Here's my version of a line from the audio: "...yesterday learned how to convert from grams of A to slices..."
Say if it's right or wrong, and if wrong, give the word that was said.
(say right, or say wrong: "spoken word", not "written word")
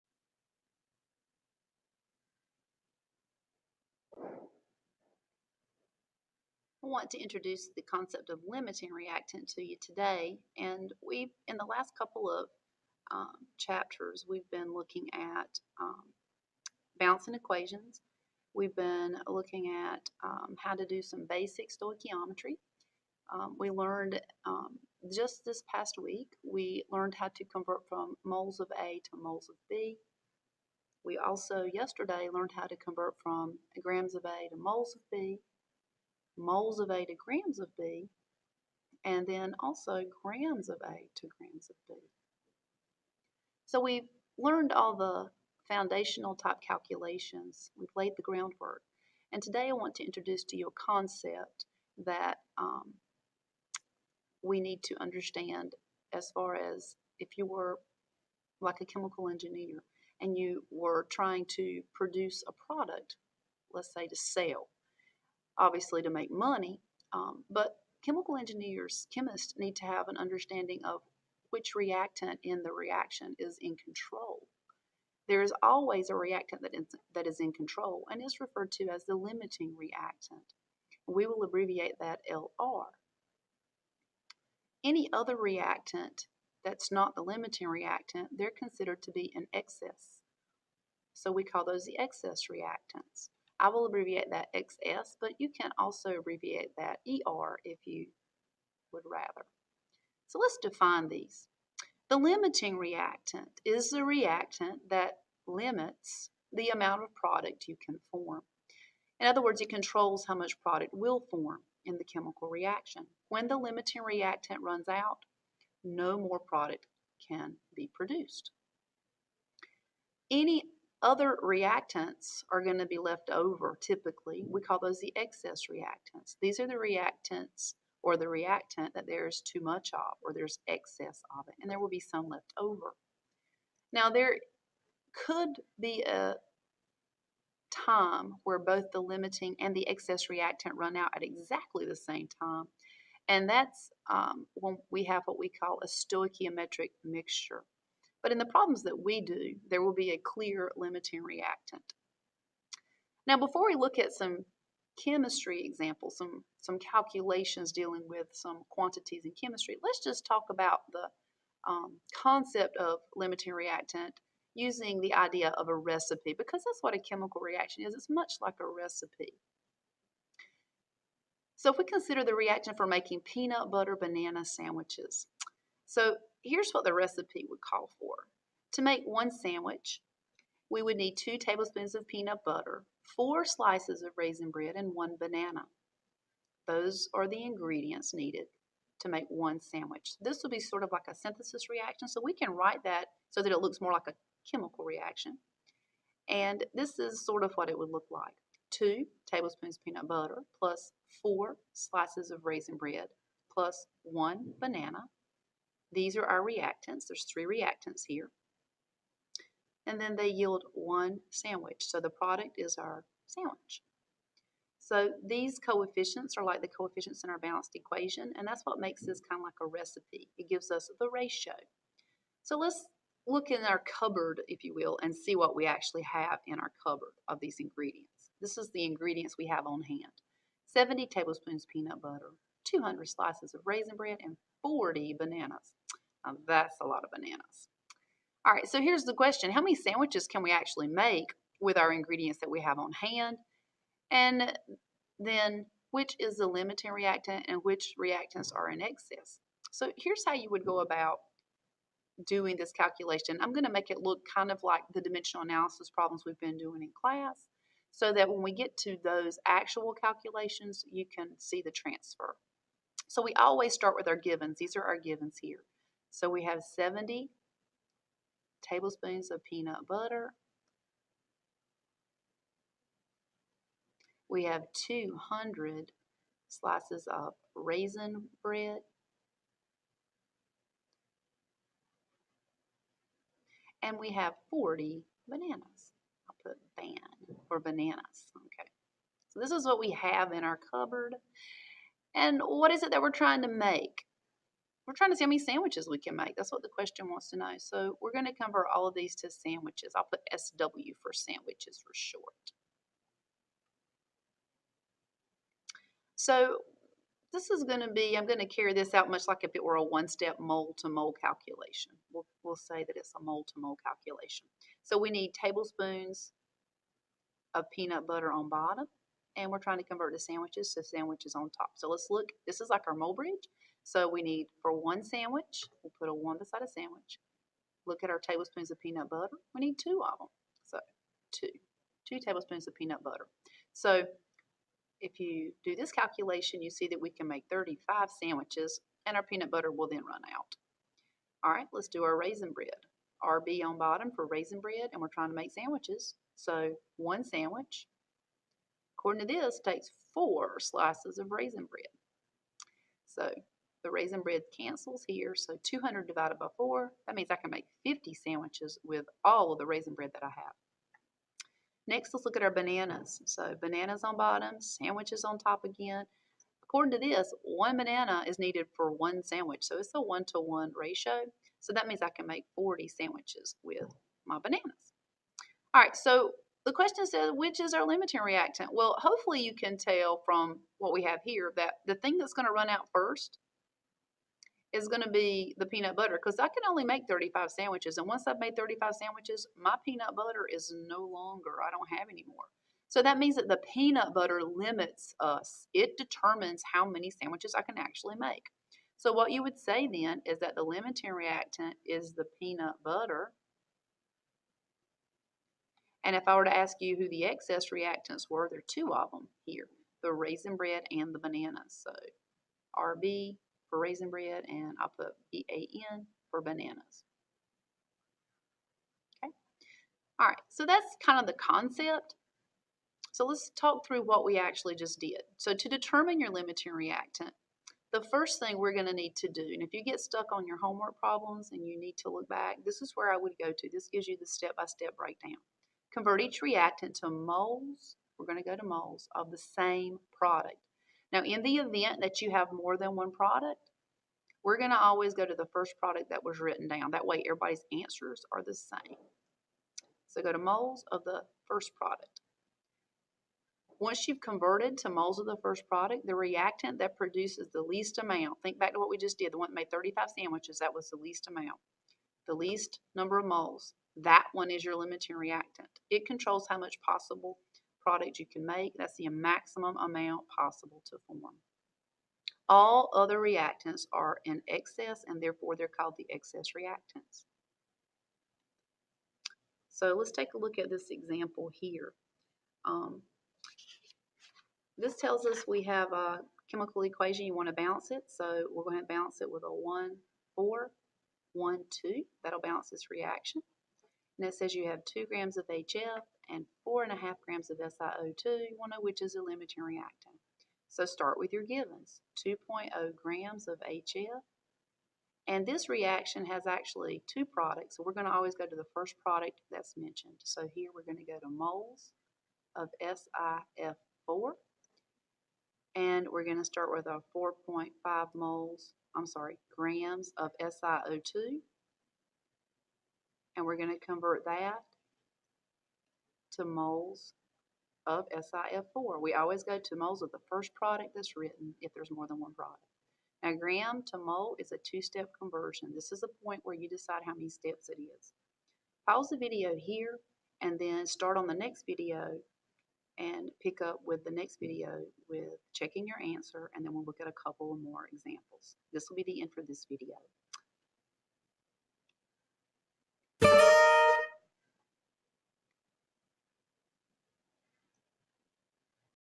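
wrong: "moles", not "slices".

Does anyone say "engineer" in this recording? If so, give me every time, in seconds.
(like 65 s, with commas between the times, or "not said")
59 s, 68 s.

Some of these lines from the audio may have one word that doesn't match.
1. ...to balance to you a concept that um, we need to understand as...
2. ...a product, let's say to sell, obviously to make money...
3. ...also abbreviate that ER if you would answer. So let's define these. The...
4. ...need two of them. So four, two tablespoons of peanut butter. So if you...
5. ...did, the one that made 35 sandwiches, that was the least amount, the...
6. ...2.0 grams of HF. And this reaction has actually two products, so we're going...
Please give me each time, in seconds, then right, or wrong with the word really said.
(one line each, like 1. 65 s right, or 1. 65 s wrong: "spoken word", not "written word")
1. 49 s wrong: "introduce", not "balance"
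2. 62 s right
3. 95 s wrong: "rather", not "answer"
4. 329 s wrong: "two", not "four"
5. 459 s right
6. 502 s right.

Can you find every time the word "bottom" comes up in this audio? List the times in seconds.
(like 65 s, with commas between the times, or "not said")
318 s, 343 s, 364 s.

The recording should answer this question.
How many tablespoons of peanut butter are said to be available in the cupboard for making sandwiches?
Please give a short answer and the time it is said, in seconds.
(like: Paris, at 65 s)
70, at 230 s.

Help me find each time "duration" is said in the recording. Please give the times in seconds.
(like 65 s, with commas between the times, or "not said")
not said.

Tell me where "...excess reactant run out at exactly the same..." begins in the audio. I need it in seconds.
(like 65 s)
139 s.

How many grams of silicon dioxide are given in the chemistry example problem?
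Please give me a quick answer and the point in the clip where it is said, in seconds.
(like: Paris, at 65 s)
4.5 grams, at 496 s.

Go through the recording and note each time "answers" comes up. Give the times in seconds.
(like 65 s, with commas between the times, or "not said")
447 s, 546 s.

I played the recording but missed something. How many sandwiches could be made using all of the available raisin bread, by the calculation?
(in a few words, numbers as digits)
50.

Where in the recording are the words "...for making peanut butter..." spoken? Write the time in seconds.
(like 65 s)
172 s.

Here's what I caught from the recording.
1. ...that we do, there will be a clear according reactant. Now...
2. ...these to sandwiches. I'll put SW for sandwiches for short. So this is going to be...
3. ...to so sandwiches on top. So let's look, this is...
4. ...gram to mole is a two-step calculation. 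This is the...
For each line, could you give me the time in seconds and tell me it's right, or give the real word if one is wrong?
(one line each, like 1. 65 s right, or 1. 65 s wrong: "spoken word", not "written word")
1. 148 s wrong: "limiting", not "according"
2. 298 s right
3. 320 s right
4. 533 s wrong: "conversion", not "calculation".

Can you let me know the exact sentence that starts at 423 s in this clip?
So let's talk through what we actually just did.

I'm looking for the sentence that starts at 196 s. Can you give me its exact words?
And this is sort of what it would look like.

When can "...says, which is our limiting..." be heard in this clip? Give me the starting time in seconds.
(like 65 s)
377 s.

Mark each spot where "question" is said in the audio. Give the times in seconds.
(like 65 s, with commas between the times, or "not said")
239 s, 296 s, 376 s.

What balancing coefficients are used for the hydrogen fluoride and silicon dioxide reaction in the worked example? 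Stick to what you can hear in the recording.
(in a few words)
1, 4, 1, 2.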